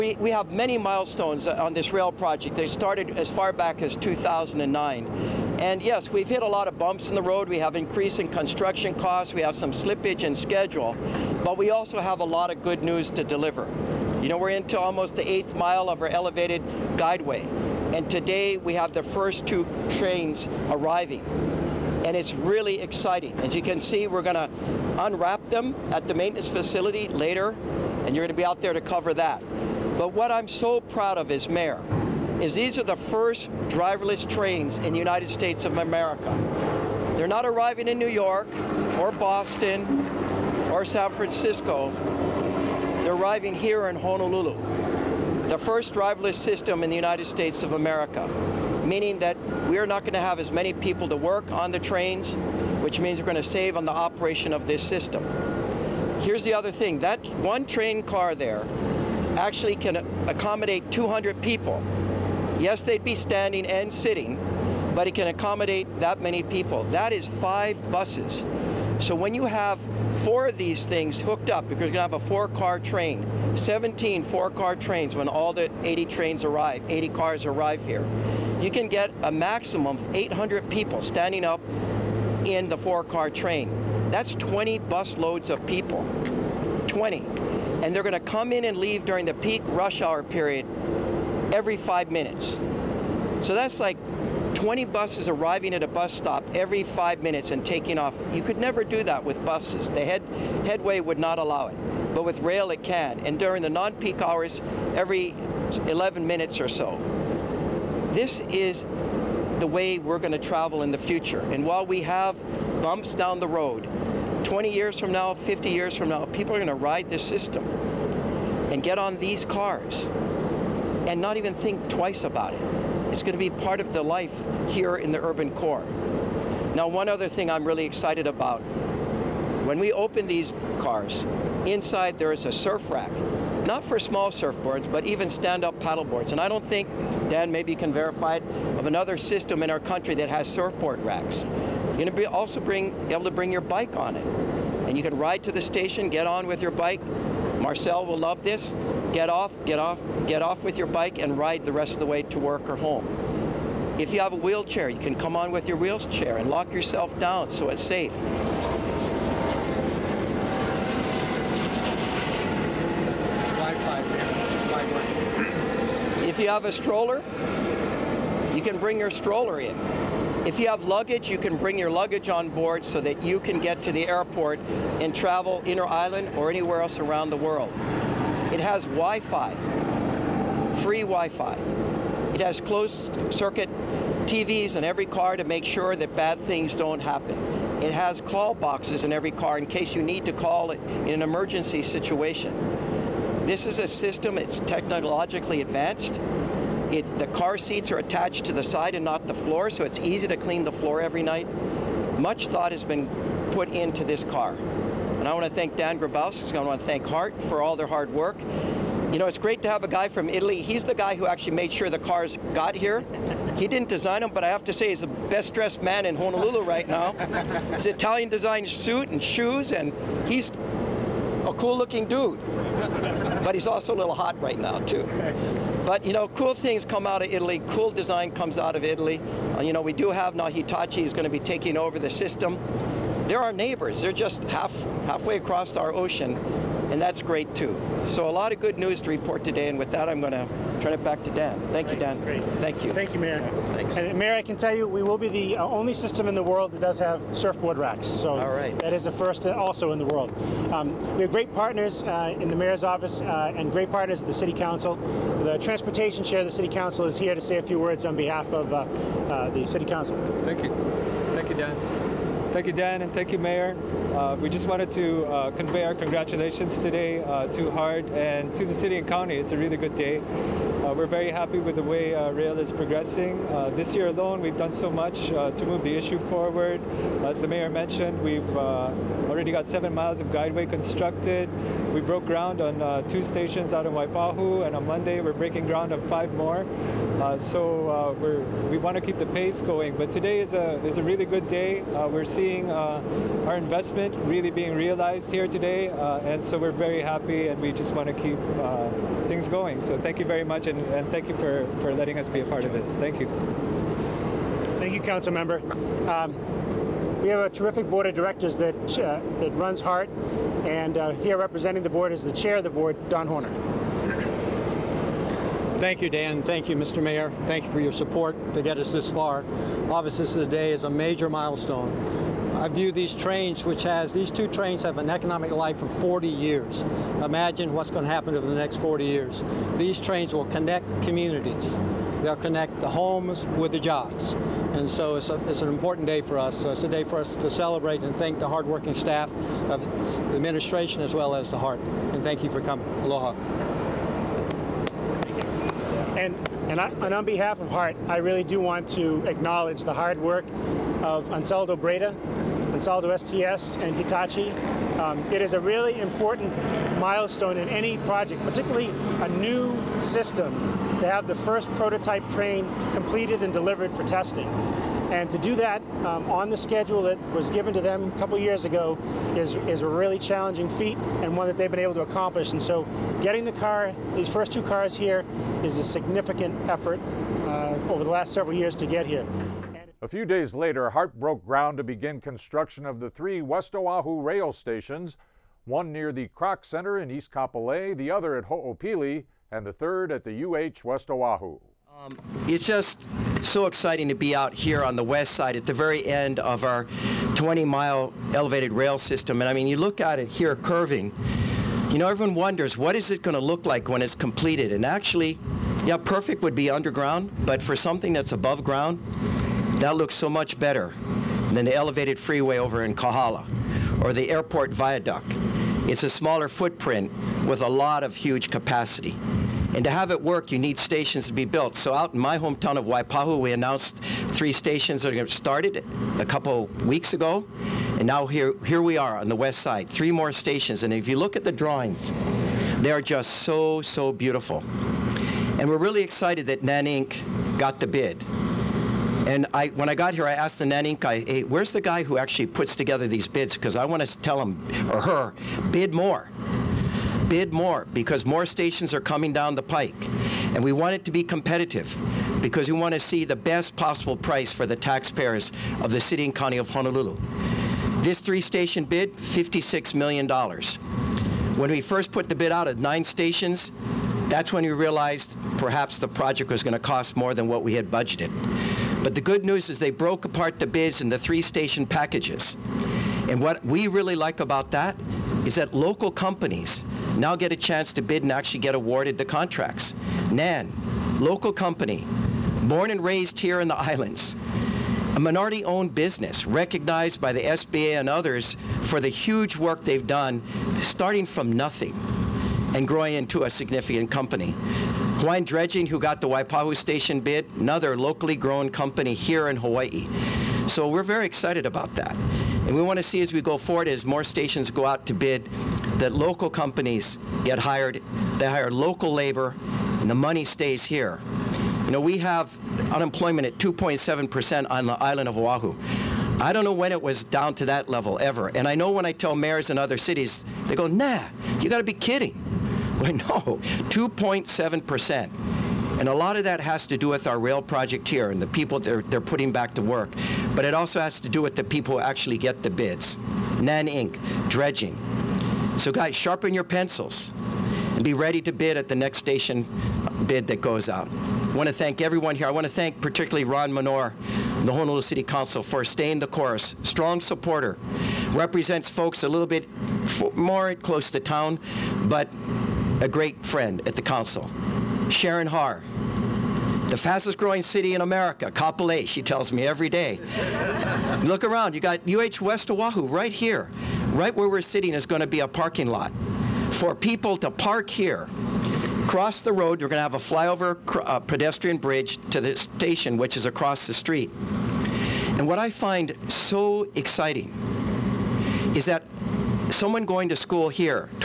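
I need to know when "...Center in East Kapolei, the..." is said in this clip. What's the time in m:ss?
6:26.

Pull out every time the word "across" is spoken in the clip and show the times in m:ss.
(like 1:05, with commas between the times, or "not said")
3:55, 9:33.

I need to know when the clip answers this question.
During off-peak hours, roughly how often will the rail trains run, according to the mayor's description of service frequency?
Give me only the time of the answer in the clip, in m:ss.
1:44.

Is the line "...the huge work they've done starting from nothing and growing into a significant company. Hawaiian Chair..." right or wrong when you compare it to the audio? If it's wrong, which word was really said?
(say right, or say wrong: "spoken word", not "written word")
wrong: "Dredging", not "Chair".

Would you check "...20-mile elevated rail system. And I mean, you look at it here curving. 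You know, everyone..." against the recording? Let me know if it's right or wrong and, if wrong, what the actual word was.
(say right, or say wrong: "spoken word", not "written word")
right.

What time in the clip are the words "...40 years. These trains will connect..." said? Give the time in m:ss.
5:28.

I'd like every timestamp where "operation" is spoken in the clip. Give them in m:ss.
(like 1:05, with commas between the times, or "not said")
0:53.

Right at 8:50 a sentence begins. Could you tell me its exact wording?
But it also has to do with the people who actually get the bids.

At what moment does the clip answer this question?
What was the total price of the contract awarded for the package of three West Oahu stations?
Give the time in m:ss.
7:39.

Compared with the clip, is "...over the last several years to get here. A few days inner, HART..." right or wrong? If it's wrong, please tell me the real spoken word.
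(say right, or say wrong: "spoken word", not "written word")
wrong: "later", not "inner".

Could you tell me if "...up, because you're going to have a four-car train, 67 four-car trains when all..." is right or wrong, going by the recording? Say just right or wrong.
wrong.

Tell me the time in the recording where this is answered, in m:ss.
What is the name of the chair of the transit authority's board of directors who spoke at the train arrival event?
5:13.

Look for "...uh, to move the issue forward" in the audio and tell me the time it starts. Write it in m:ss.
4:35.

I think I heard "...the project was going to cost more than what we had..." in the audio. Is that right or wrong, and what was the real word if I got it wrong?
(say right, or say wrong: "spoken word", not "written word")
right.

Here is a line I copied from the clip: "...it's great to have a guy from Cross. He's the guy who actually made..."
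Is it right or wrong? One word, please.
wrong.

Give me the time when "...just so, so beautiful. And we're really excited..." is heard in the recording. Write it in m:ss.
7:13.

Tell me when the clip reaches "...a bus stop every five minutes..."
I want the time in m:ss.
1:35.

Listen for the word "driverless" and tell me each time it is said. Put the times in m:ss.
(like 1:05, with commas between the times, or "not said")
0:33, 0:45.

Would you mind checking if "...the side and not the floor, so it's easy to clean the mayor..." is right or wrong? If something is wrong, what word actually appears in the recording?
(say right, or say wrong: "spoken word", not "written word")
wrong: "floor", not "mayor".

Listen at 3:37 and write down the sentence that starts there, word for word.
His Italian designed suit and shoes, and he's a cool looking dude.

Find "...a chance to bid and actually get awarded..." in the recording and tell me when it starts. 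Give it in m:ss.
7:57.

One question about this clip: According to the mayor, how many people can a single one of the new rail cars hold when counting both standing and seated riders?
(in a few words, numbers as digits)
200.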